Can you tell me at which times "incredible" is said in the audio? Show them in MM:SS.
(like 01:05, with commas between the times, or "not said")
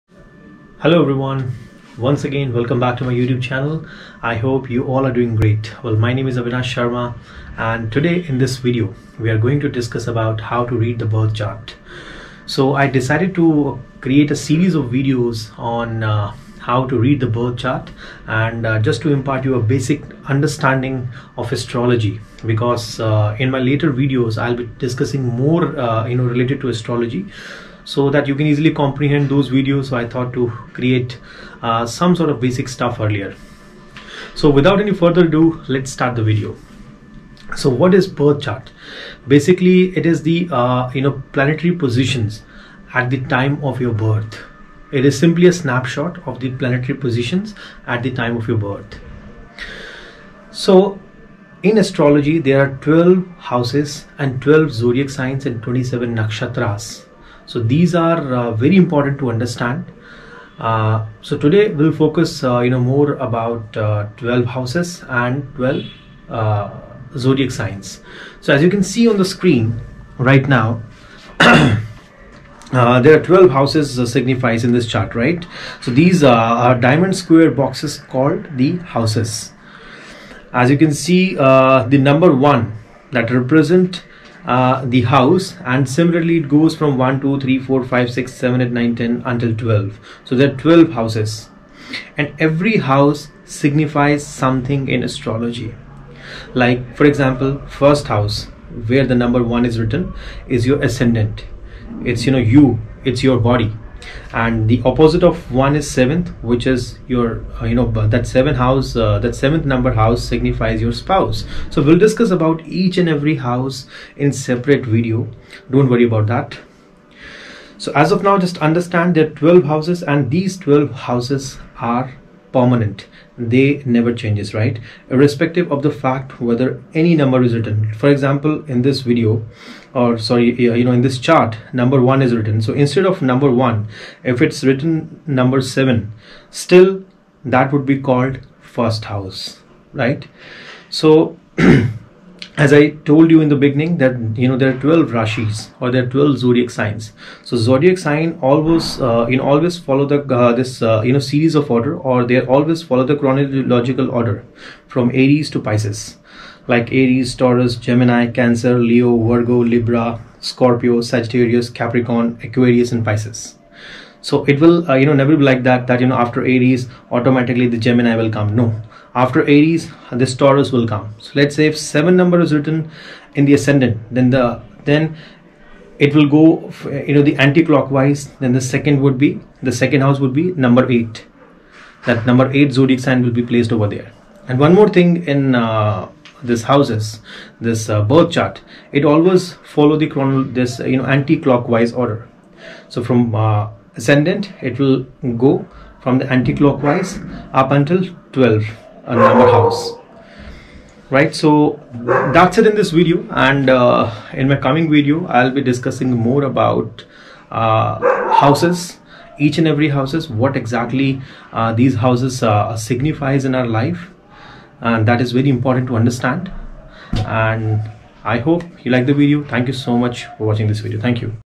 not said.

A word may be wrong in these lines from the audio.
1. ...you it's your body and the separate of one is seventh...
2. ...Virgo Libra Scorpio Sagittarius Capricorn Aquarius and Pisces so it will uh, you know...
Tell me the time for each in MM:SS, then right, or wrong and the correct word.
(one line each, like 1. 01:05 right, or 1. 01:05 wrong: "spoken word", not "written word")
1. 01:42 wrong: "opposite", not "separate"
2. 02:39 right.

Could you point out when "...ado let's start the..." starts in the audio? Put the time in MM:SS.
00:35.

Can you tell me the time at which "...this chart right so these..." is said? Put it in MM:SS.
01:14.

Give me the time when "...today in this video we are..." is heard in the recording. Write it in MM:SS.
00:07.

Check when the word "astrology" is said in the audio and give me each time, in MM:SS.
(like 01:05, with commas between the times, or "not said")
00:21, 00:26, 00:51, 01:35.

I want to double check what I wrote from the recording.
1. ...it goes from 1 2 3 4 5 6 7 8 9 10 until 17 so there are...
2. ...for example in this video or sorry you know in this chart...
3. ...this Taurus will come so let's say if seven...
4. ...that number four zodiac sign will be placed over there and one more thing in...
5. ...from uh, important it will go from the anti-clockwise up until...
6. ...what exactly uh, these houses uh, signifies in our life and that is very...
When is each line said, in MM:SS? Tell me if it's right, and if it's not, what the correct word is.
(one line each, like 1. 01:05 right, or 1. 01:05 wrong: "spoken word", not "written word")
1. 01:26 wrong: "12", not "17"
2. 02:07 right
3. 02:50 right
4. 03:02 wrong: "eight", not "four"
5. 03:13 wrong: "ascendant", not "important"
6. 03:30 right.